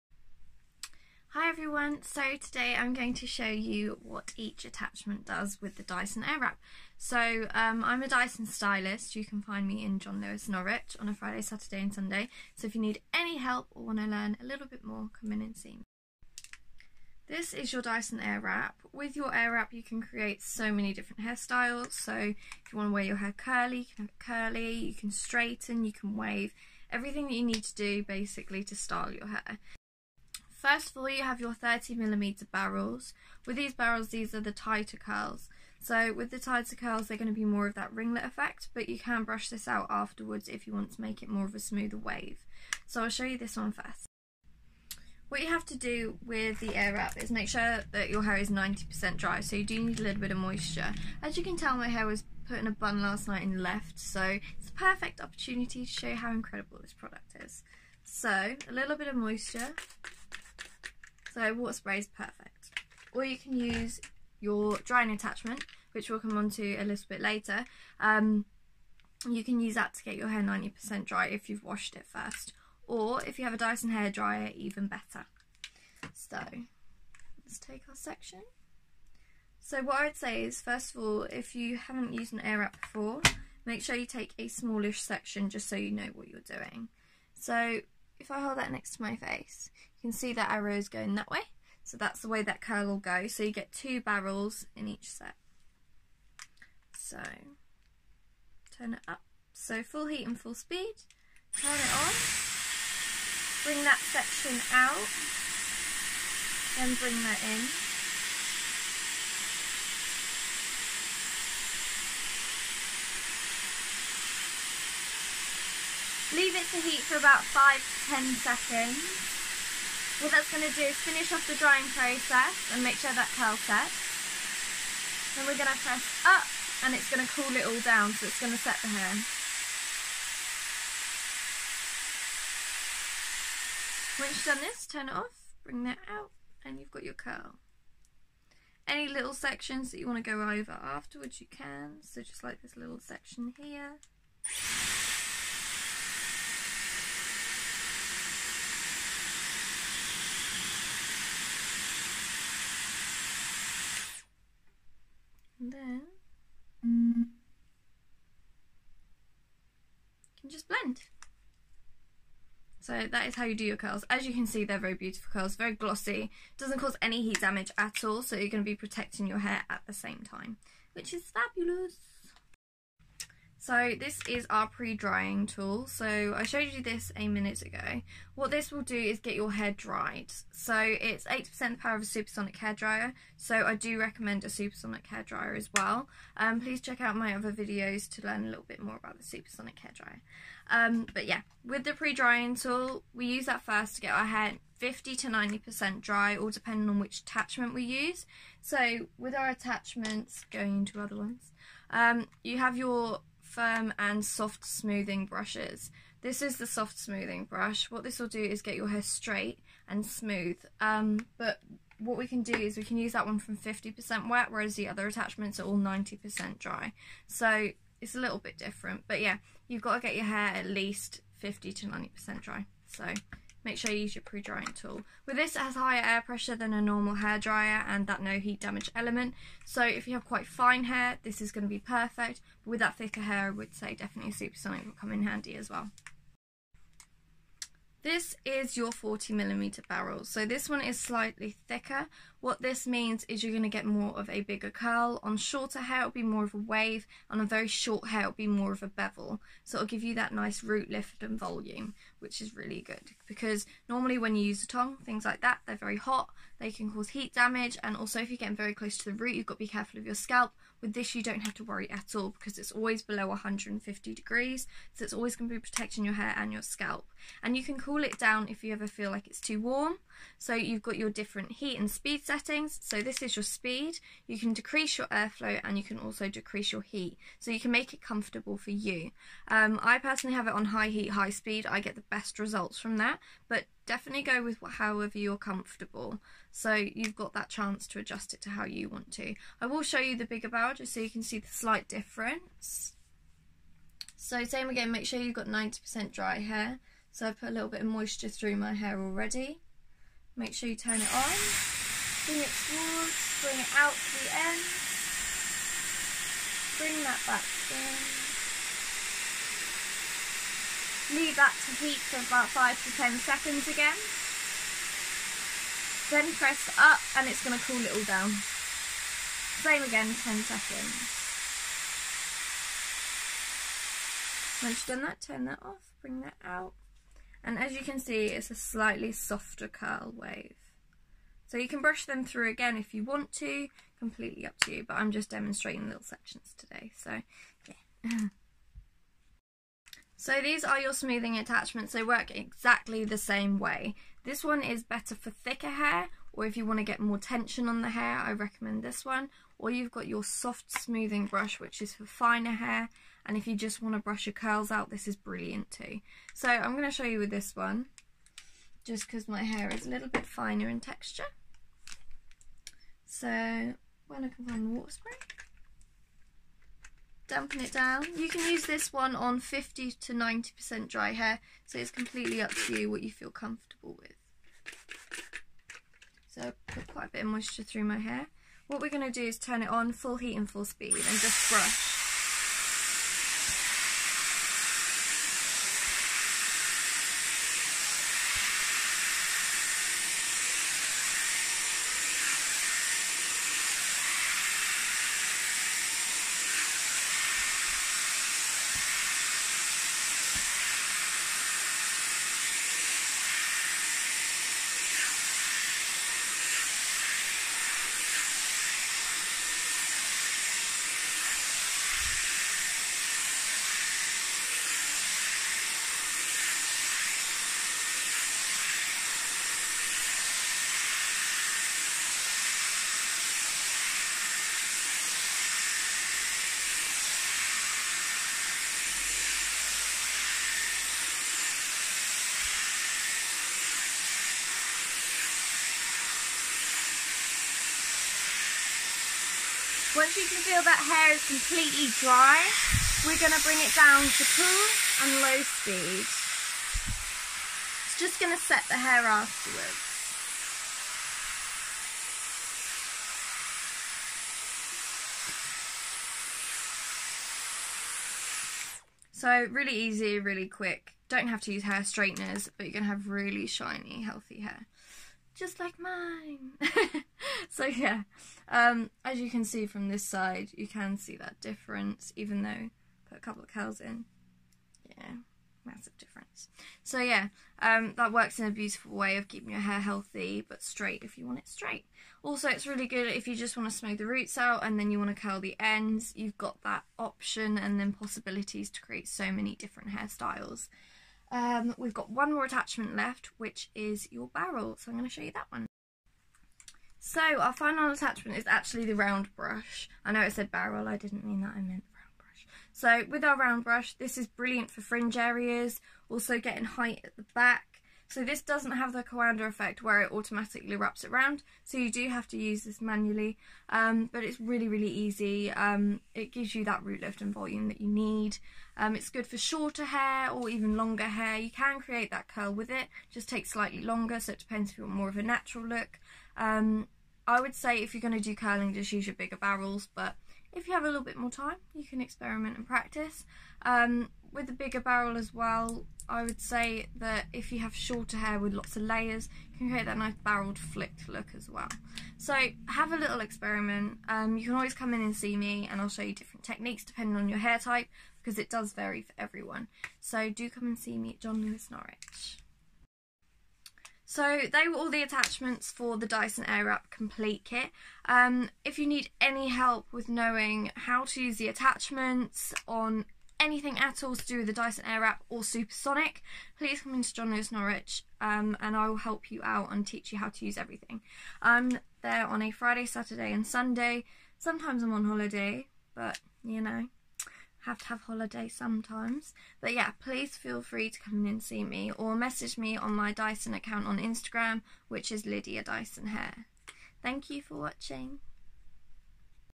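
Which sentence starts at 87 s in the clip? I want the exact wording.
So if I hold that next to my face, you can see that arrow is going that way.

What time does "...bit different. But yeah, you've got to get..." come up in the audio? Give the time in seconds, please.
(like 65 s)
218 s.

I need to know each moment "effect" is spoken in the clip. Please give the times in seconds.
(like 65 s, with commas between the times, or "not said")
38 s, 509 s.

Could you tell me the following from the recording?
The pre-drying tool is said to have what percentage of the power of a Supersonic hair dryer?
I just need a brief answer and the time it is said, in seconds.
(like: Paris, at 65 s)
80%, at 181 s.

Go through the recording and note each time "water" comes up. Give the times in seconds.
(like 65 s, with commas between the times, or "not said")
61 s, 364 s.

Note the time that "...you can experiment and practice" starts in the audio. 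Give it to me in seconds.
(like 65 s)
531 s.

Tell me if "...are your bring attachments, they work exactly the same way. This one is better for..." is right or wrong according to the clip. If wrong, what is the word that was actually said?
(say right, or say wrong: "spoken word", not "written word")
wrong: "smoothing", not "bring".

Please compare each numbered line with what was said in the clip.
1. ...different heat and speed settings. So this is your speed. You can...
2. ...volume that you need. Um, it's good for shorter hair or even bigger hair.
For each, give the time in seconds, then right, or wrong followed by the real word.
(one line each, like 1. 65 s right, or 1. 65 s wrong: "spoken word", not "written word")
1. 271 s right
2. 517 s wrong: "longer", not "bigger".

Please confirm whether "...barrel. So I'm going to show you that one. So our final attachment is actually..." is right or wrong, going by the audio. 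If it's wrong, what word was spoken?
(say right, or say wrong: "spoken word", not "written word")
right.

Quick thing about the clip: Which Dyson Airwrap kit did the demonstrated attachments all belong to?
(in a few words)
Complete Kit.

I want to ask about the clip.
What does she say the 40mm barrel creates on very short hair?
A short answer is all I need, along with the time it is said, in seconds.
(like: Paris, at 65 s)
a bevel, at 248 s.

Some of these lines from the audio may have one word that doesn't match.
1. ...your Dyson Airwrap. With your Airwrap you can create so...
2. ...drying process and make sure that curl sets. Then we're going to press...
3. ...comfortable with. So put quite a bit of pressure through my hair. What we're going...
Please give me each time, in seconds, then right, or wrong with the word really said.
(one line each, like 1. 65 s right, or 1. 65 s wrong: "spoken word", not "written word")
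1. 17 s right
2. 121 s right
3. 373 s wrong: "moisture", not "pressure".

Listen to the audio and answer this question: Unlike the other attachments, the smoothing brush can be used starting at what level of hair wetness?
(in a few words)
50%.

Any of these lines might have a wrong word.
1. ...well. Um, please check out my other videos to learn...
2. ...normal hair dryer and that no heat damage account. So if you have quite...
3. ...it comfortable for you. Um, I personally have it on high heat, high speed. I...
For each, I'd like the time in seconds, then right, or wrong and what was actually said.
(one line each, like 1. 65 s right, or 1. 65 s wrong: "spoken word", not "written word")
1. 185 s right
2. 226 s wrong: "element", not "account"
3. 277 s right.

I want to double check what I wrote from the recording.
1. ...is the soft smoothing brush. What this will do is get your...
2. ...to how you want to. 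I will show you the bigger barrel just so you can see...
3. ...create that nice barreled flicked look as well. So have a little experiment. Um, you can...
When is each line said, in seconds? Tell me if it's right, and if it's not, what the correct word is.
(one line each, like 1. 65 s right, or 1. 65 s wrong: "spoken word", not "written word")
1. 206 s right
2. 288 s right
3. 539 s right.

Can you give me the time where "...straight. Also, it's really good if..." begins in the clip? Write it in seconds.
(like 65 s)
481 s.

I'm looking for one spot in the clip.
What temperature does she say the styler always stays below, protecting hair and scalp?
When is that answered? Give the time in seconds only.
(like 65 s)
263 s.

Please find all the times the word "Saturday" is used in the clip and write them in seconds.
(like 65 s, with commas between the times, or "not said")
11 s, 572 s.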